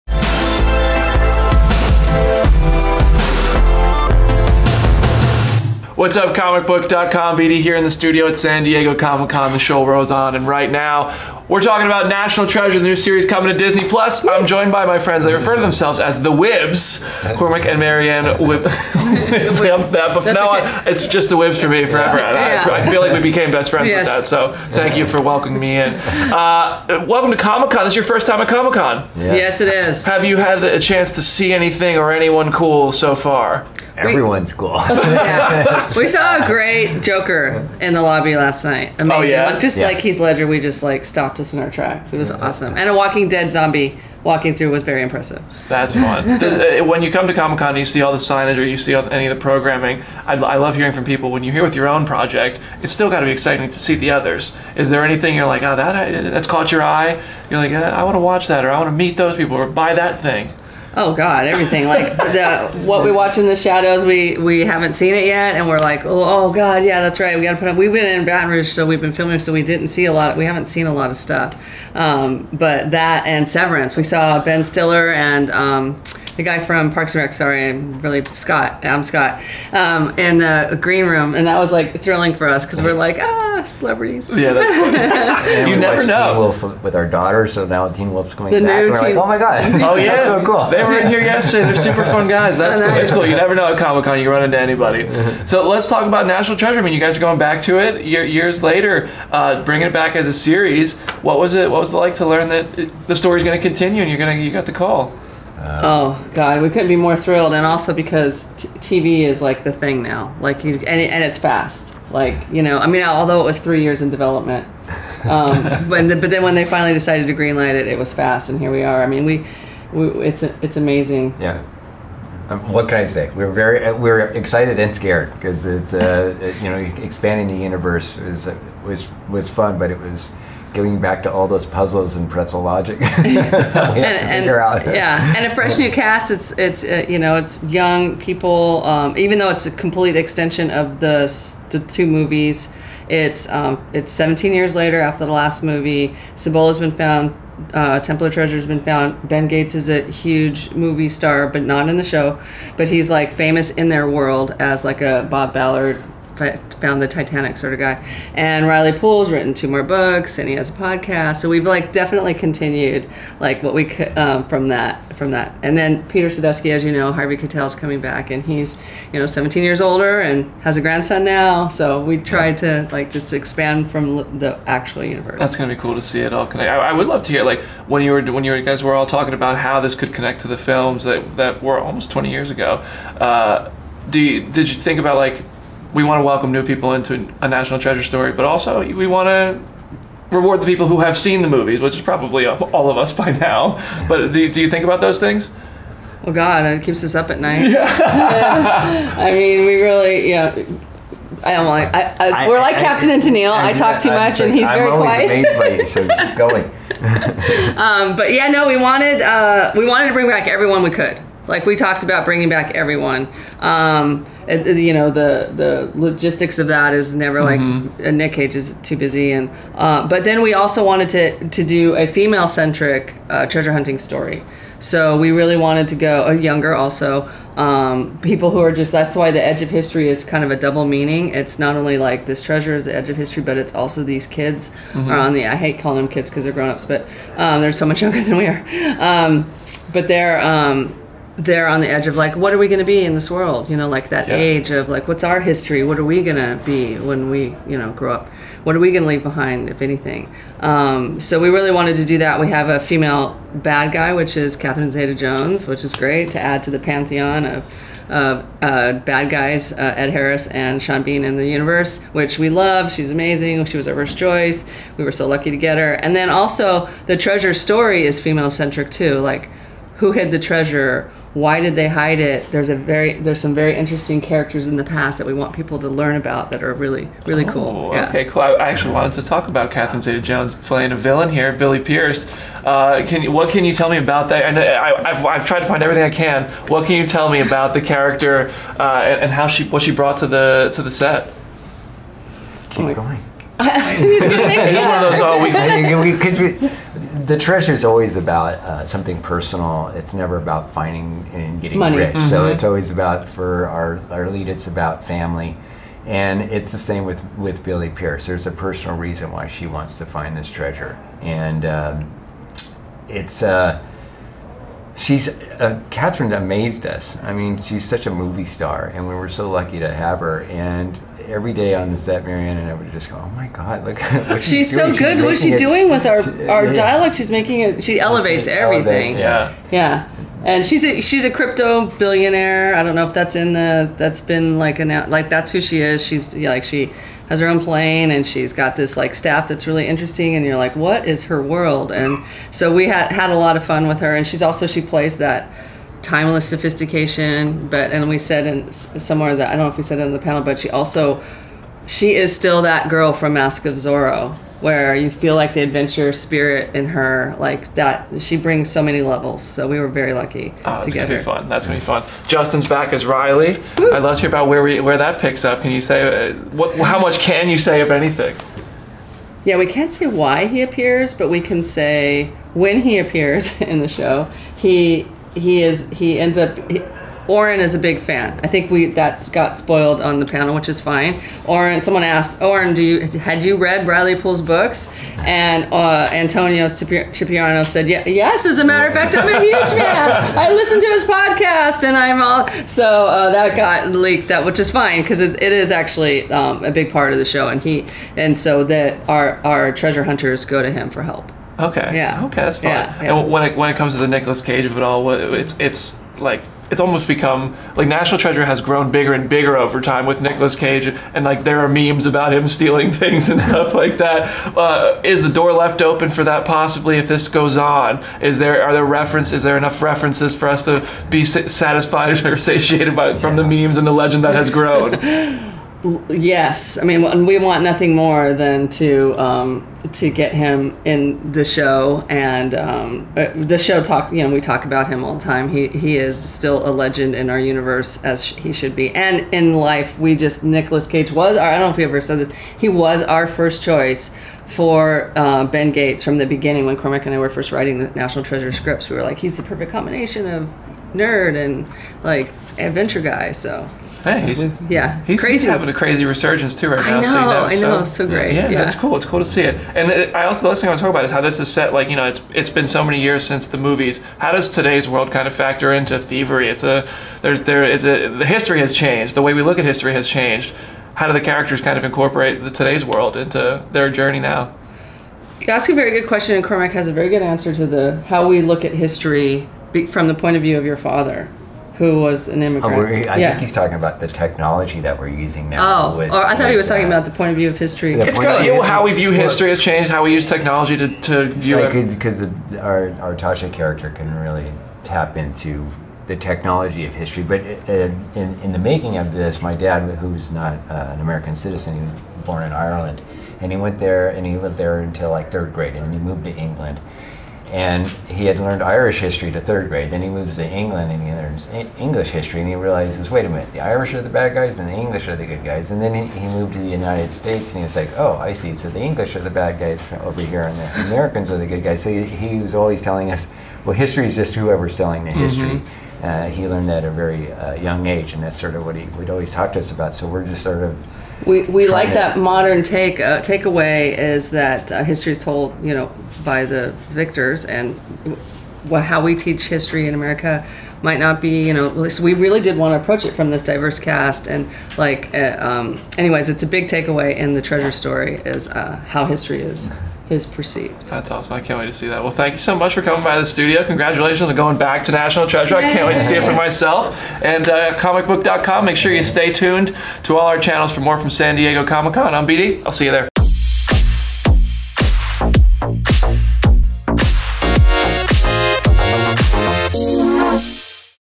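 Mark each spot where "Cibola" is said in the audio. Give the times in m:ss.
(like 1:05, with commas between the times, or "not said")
2:26.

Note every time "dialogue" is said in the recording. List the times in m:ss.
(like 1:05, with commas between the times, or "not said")
5:26.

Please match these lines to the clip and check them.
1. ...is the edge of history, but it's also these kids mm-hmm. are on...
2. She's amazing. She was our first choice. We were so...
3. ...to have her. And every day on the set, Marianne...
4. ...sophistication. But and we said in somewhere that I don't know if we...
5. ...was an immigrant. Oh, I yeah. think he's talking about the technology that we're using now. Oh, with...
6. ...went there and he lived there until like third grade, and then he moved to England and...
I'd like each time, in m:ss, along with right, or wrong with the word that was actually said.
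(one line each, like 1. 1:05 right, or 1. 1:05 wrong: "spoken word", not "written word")
1. 3:52 right
2. 4:22 right
3. 5:19 right
4. 5:46 right
5. 8:01 right
6. 8:23 right.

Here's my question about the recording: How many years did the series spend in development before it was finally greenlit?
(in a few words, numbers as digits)
3.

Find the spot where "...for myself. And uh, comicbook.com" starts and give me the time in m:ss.
9:16.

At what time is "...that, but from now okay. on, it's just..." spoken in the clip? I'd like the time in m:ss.
0:18.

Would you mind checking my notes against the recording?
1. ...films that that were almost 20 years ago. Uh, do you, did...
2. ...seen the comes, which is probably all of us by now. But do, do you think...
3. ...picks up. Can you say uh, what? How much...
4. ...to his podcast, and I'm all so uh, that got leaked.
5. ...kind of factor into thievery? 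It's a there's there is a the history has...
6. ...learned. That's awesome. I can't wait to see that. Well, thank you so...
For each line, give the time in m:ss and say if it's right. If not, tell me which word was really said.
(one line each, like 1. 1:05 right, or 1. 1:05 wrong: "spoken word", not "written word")
1. 3:00 right
2. 3:11 wrong: "movies", not "comes"
3. 6:05 right
4. 6:30 right
5. 7:45 right
6. 9:10 wrong: "perceived", not "learned".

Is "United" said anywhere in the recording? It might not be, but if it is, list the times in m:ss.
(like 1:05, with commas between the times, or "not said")
8:36.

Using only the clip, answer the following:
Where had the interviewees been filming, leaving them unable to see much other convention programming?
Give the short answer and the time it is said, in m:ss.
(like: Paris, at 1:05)
Baton Rouge, at 1:08.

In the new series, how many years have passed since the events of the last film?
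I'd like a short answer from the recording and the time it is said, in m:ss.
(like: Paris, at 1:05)
17, at 2:24.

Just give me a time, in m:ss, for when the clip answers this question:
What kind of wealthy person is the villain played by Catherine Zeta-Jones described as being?
5:31.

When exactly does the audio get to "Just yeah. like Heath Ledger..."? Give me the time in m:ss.
0:39.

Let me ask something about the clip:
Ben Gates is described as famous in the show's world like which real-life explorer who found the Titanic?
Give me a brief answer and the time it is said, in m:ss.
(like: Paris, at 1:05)
Bob Ballard, at 2:35.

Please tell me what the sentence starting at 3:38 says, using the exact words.
Nick Cage is too busy, and uh, but then we also wanted to to do a female centric uh, treasure hunting story.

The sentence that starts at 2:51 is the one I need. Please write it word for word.
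So we tried to like just expand from the actual universe.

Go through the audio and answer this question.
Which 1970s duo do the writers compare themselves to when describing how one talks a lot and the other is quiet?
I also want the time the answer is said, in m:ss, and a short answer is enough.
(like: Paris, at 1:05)
Captain and Tennille, at 3:22.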